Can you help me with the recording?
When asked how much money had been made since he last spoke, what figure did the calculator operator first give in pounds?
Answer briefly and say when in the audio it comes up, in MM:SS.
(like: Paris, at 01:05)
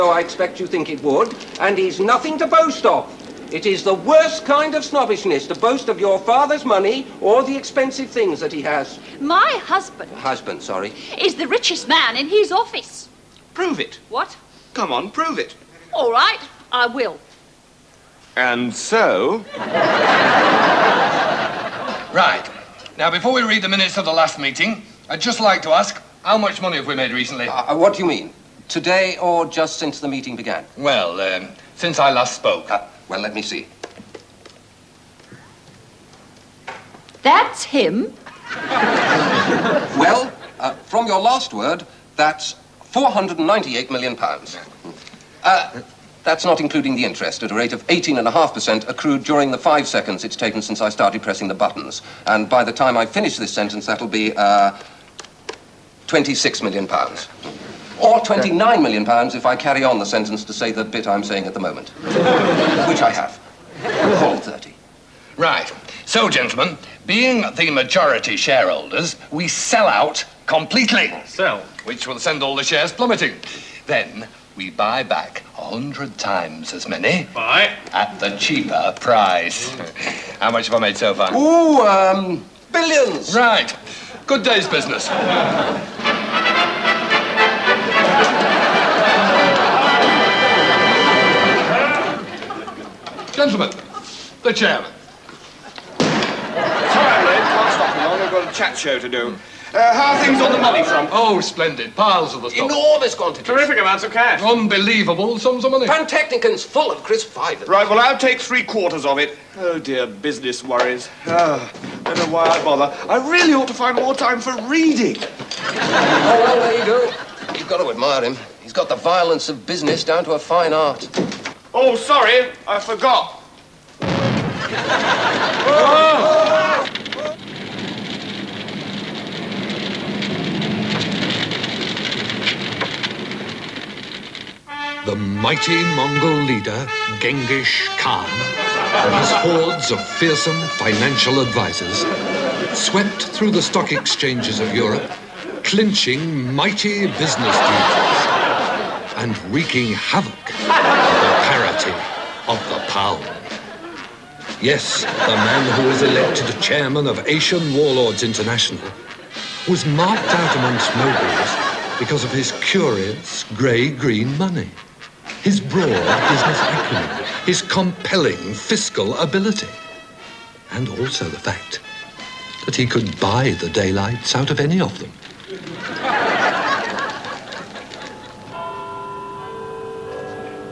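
498 million pounds, at 00:42.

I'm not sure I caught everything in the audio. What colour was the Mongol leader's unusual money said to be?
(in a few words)
grey-green.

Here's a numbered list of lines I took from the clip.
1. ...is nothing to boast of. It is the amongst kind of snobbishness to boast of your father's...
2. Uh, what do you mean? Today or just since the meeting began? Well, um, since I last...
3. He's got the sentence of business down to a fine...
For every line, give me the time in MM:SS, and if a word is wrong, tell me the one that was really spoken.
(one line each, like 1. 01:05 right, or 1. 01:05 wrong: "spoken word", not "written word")
1. 00:01 wrong: "worst", not "amongst"
2. 00:27 right
3. 01:58 wrong: "violence", not "sentence".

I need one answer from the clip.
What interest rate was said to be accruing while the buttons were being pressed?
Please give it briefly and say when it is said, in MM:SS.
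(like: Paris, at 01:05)
18.5%, at 00:47.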